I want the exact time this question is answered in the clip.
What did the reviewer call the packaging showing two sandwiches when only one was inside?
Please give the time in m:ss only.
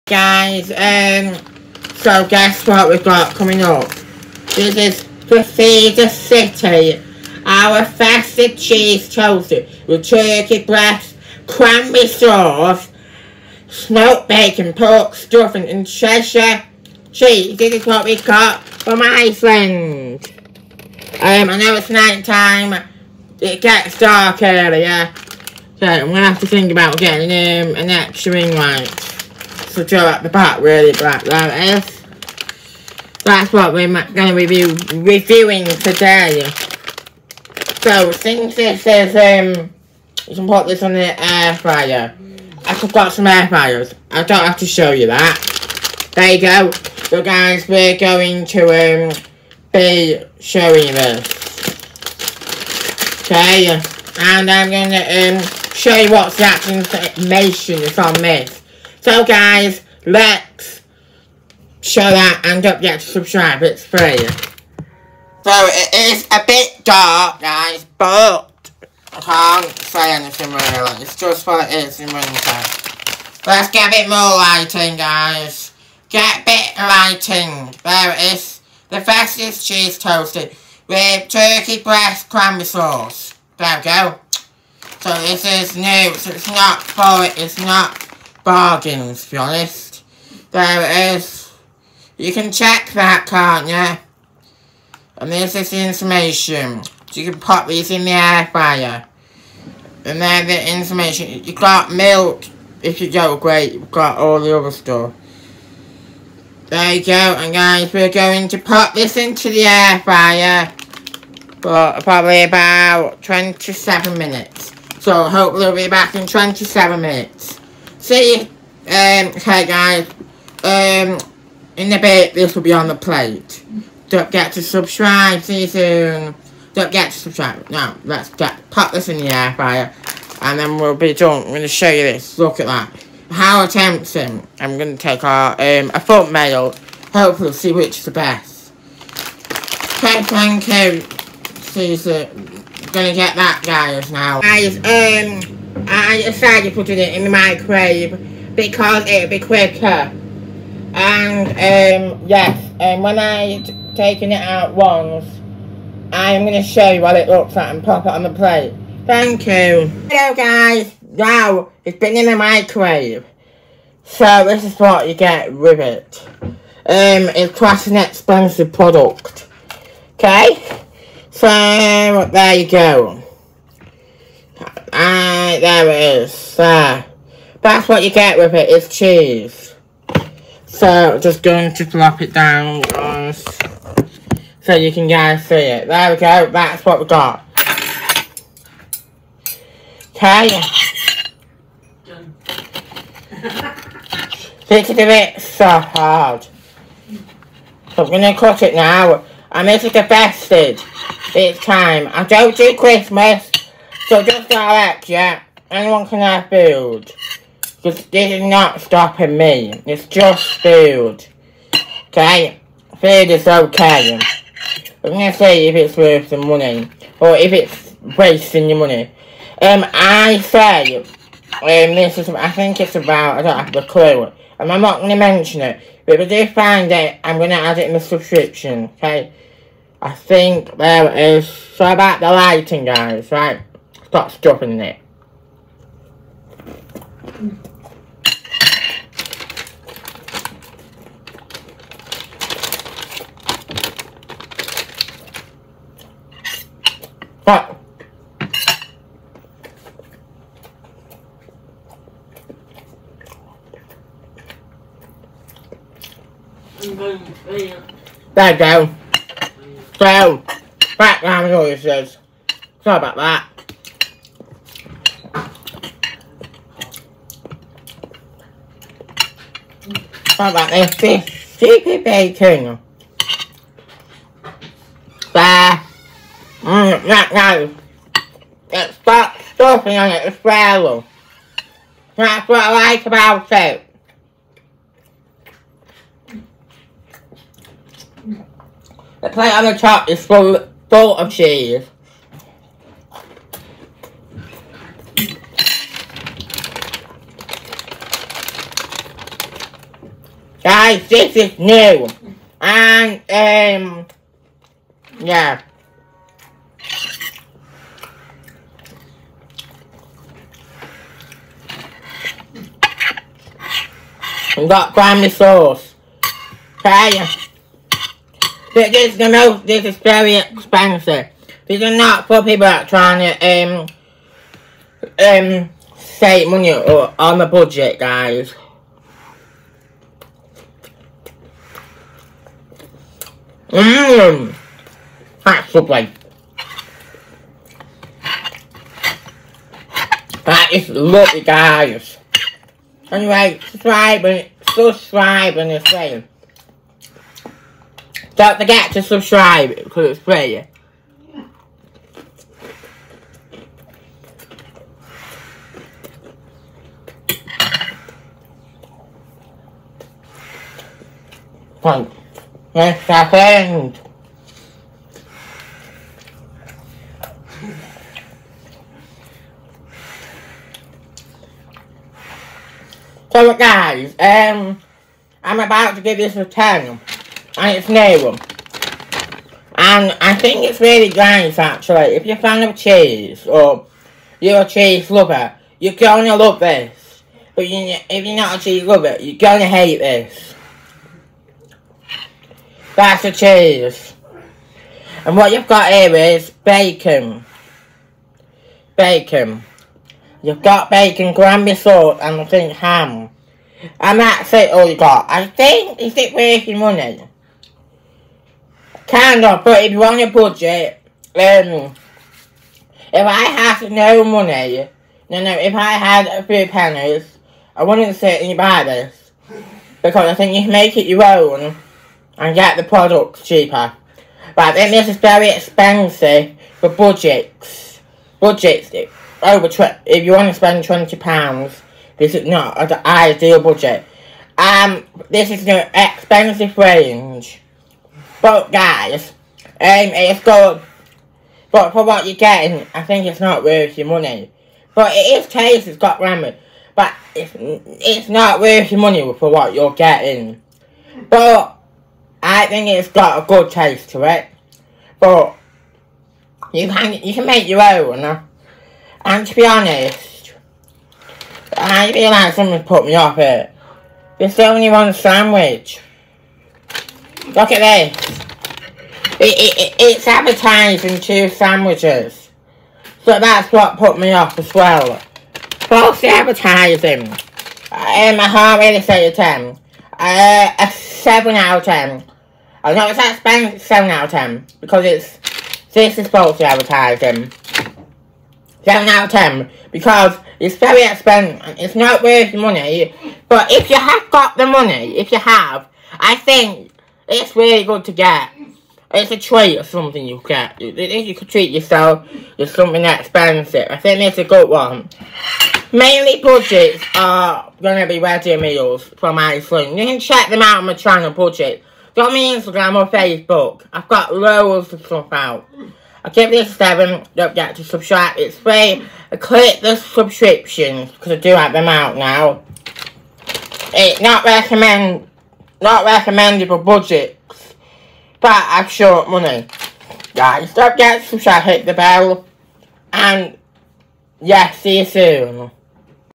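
7:55.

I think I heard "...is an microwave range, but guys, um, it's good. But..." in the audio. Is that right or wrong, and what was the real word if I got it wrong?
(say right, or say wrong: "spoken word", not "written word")
wrong: "expensive", not "microwave".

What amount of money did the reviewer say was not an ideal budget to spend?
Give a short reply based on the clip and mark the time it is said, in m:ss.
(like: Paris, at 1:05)
twenty pounds, at 7:10.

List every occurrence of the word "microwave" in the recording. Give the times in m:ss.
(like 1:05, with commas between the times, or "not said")
2:27, 2:42.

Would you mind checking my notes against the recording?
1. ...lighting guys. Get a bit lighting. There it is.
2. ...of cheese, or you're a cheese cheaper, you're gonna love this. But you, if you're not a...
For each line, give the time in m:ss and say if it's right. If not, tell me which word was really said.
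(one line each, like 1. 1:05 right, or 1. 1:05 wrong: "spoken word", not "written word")
1. 1:14 right
2. 6:22 wrong: "lover", not "cheaper".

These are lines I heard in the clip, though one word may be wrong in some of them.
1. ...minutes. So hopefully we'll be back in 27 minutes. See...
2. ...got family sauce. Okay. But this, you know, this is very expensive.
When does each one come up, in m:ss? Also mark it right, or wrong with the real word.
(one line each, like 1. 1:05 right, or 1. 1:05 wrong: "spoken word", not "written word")
1. 1:54 right
2. 5:14 right.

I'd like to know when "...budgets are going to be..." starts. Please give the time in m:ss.
8:26.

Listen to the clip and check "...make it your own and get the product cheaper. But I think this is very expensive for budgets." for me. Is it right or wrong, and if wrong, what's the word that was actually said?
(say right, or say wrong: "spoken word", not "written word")
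right.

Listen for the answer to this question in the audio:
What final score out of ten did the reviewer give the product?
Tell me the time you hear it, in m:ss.
8:00.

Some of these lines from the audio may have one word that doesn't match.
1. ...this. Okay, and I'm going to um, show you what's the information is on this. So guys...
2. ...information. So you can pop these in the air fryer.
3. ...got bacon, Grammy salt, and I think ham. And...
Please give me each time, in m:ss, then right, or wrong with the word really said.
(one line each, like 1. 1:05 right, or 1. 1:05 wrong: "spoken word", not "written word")
1. 0:50 right
2. 1:35 right
3. 6:40 right.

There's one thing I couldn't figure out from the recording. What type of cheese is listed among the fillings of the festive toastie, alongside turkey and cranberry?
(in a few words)
Cheshire cheese.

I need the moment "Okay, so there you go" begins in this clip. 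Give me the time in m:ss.
2:50.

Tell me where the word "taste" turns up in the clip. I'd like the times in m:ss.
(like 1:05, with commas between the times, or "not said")
7:25, 7:33.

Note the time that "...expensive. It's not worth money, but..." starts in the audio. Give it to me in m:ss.
8:11.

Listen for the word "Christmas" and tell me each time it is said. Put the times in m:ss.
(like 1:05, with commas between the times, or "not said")
3:22.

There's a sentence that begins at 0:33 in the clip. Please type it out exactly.
That's what we're going to be reviewing today.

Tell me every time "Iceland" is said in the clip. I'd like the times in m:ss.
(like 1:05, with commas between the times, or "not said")
0:19, 8:29.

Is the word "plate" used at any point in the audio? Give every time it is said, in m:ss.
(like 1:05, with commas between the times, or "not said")
2:02, 2:38, 4:49.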